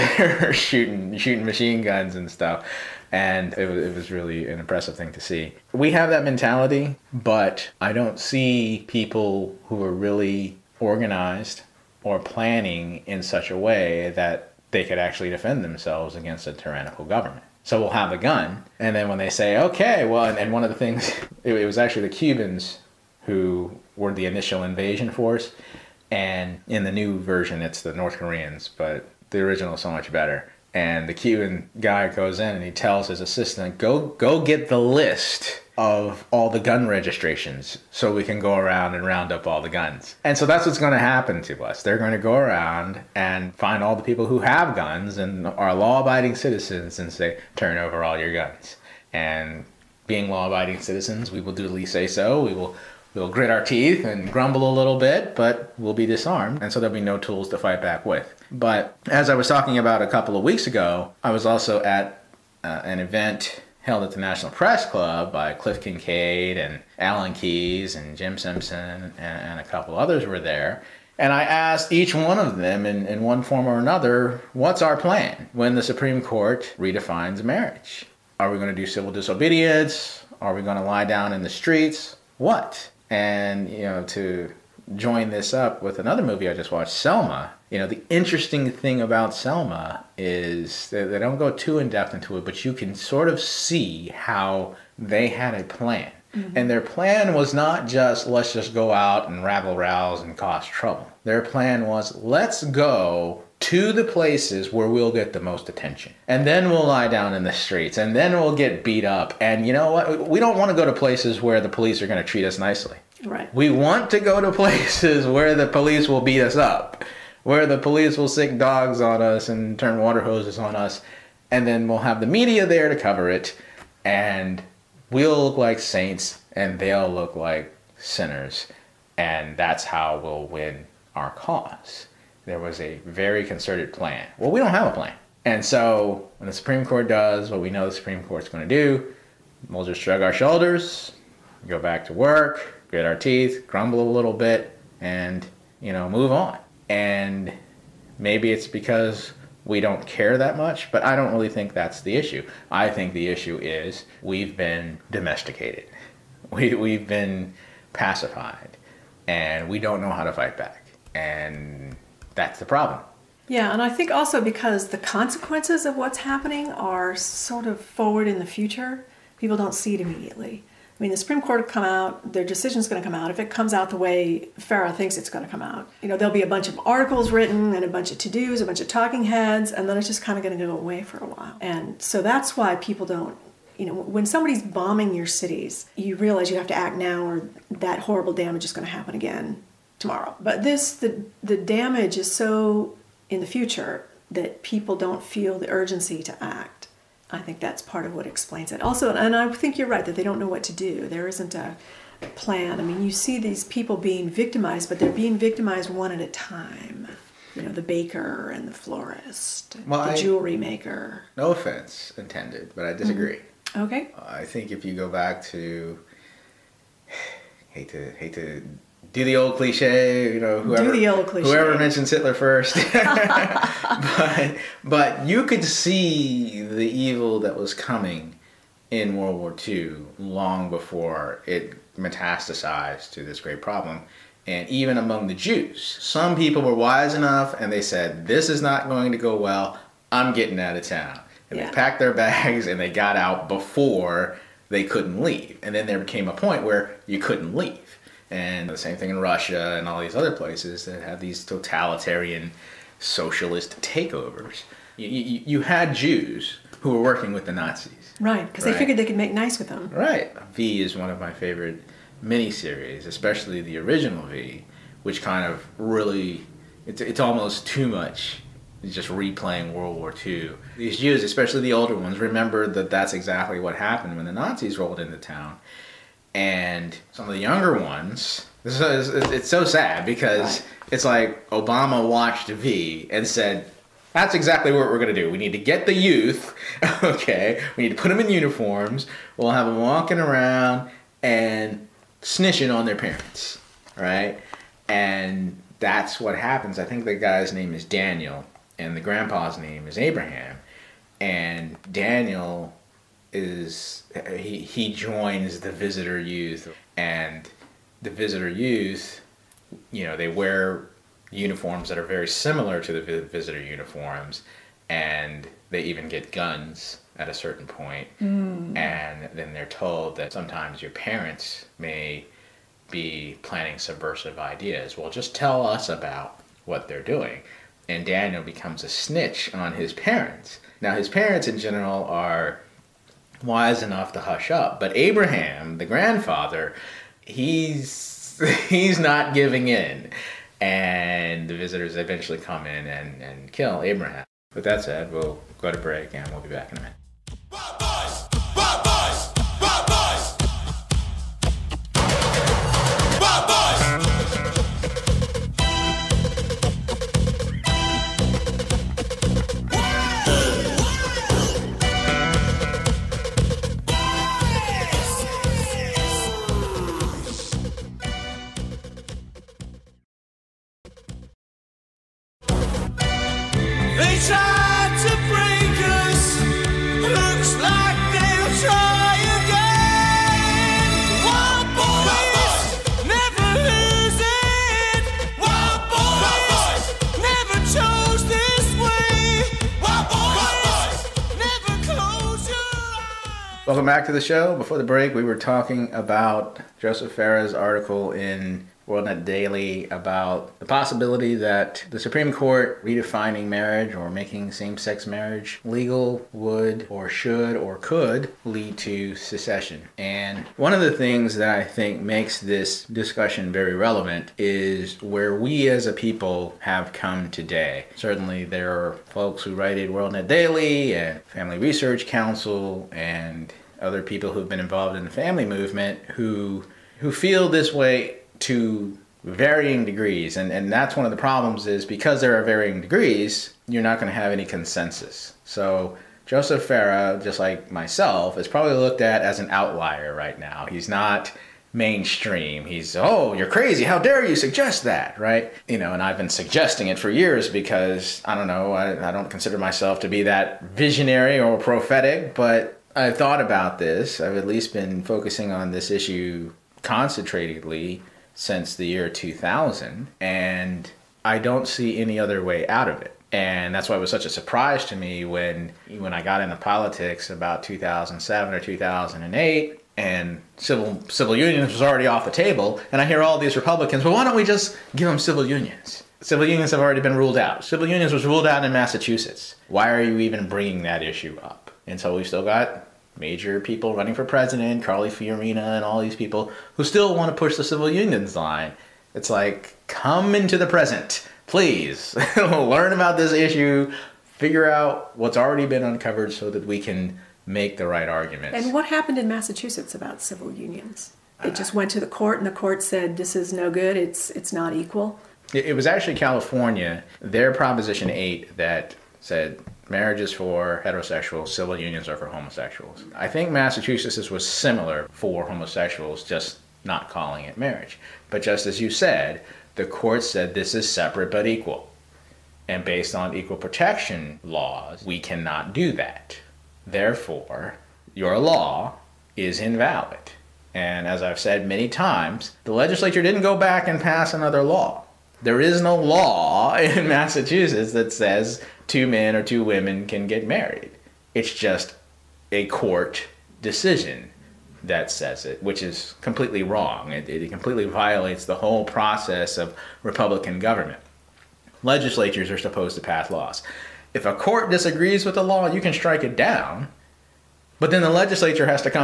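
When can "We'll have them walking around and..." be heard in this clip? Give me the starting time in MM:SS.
04:49.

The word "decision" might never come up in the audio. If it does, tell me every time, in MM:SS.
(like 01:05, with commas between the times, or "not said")
02:52, 09:03.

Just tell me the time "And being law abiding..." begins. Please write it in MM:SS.
00:49.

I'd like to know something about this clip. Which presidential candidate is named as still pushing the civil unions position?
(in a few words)
Carly Fiorina.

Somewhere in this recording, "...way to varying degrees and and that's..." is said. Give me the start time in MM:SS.
07:07.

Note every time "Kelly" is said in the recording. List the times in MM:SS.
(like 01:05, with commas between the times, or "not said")
not said.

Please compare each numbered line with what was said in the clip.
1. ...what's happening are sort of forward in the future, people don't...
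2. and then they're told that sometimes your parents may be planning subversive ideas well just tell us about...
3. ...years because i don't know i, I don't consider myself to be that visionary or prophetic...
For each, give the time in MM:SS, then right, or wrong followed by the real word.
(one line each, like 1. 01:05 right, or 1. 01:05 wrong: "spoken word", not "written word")
1. 02:45 right
2. 05:18 right
3. 07:27 right.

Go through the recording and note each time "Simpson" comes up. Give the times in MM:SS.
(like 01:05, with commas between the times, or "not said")
01:08.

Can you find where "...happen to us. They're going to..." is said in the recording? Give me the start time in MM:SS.
00:40.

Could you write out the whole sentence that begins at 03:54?
And even among the Jews, some people were wise enough and they said, This is not going to go well.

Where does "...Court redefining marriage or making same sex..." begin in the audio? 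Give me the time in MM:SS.
06:42.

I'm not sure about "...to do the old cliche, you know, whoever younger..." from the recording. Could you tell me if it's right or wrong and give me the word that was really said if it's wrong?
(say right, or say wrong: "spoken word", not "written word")
wrong: "whoever", not "younger".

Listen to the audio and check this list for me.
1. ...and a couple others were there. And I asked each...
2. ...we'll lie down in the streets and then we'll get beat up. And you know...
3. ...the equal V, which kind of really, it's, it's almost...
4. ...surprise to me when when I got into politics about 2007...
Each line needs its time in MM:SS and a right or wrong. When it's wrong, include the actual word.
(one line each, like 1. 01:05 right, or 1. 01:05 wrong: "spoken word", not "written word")
1. 01:09 right
2. 01:46 right
3. 04:23 wrong: "original", not "equal"
4. 07:44 right.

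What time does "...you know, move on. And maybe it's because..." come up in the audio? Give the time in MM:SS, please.
02:25.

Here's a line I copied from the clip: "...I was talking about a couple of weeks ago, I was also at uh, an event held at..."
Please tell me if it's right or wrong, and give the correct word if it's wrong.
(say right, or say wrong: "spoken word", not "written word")
right.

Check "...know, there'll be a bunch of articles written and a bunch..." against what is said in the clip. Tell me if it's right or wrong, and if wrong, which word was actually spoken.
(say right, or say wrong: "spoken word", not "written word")
right.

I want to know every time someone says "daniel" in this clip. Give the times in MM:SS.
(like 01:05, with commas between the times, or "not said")
04:57, 05:01, 05:28.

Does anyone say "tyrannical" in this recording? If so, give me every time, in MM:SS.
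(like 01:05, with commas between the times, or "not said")
00:16.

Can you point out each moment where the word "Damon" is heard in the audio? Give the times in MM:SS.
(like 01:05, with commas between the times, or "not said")
not said.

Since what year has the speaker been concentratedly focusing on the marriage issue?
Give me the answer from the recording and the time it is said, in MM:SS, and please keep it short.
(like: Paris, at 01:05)
2000, at 07:38.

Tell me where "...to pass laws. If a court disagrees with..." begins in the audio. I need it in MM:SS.
09:12.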